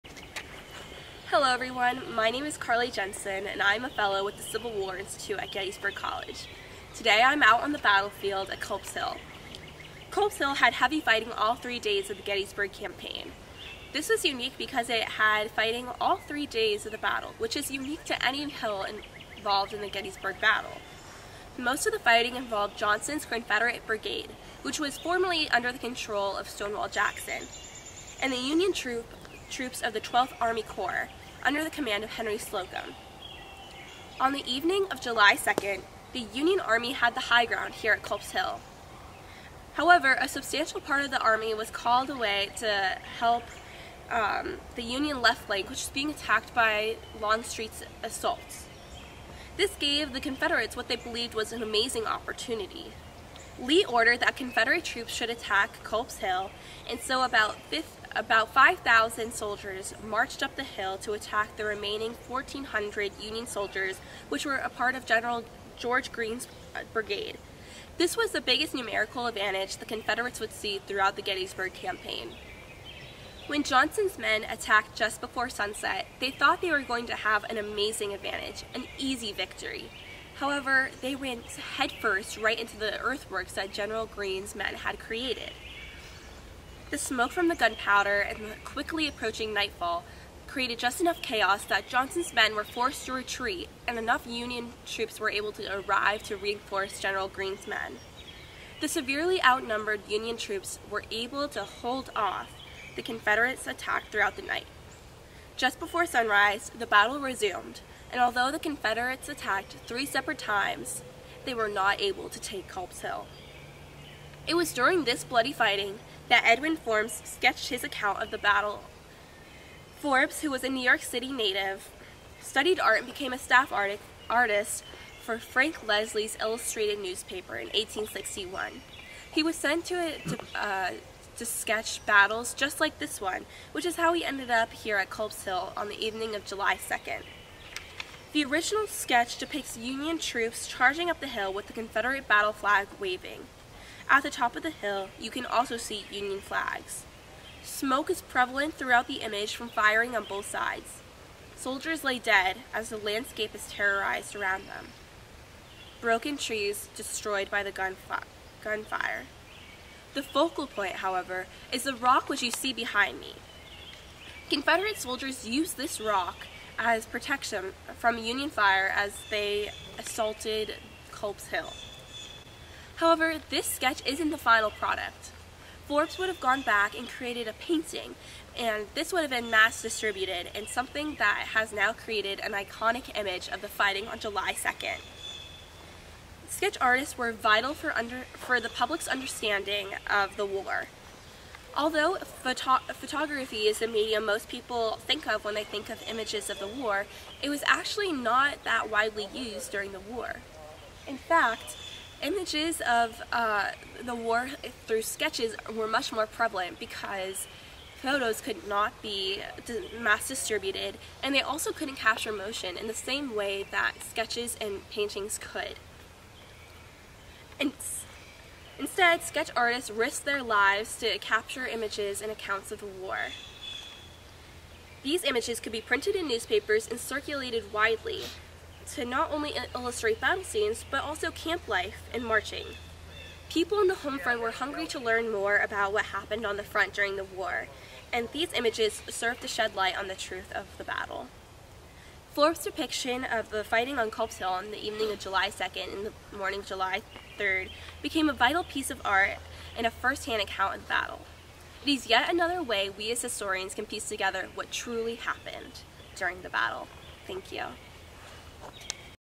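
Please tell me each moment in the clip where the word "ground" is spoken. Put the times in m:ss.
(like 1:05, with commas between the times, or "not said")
0:37.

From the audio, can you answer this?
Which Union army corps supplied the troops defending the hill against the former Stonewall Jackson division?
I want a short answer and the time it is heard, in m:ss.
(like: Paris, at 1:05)
12th Army Corps, at 0:30.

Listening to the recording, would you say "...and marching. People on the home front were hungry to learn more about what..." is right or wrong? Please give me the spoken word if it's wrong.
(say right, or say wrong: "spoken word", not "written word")
right.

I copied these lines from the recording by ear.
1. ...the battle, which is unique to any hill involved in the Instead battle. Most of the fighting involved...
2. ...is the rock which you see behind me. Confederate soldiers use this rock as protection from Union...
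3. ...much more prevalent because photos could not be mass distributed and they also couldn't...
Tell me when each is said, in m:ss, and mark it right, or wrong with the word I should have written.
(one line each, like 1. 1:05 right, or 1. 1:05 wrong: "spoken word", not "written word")
1. 0:16 wrong: "Gettysburg", not "Instead"
2. 2:41 right
3. 3:25 right.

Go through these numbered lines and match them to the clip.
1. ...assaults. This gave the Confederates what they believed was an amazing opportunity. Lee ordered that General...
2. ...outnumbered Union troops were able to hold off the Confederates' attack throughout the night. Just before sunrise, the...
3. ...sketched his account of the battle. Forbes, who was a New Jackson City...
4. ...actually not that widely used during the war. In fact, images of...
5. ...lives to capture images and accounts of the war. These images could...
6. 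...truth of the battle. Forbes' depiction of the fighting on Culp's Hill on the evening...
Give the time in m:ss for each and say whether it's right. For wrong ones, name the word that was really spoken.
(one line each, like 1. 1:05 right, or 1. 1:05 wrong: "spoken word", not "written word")
1. 0:48 wrong: "Confederate", not "General"
2. 1:39 right
3. 1:57 wrong: "York", not "Jackson"
4. 3:17 right
5. 3:40 right
6. 4:00 right.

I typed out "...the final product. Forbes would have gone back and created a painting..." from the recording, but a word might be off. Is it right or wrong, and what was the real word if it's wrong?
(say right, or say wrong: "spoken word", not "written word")
right.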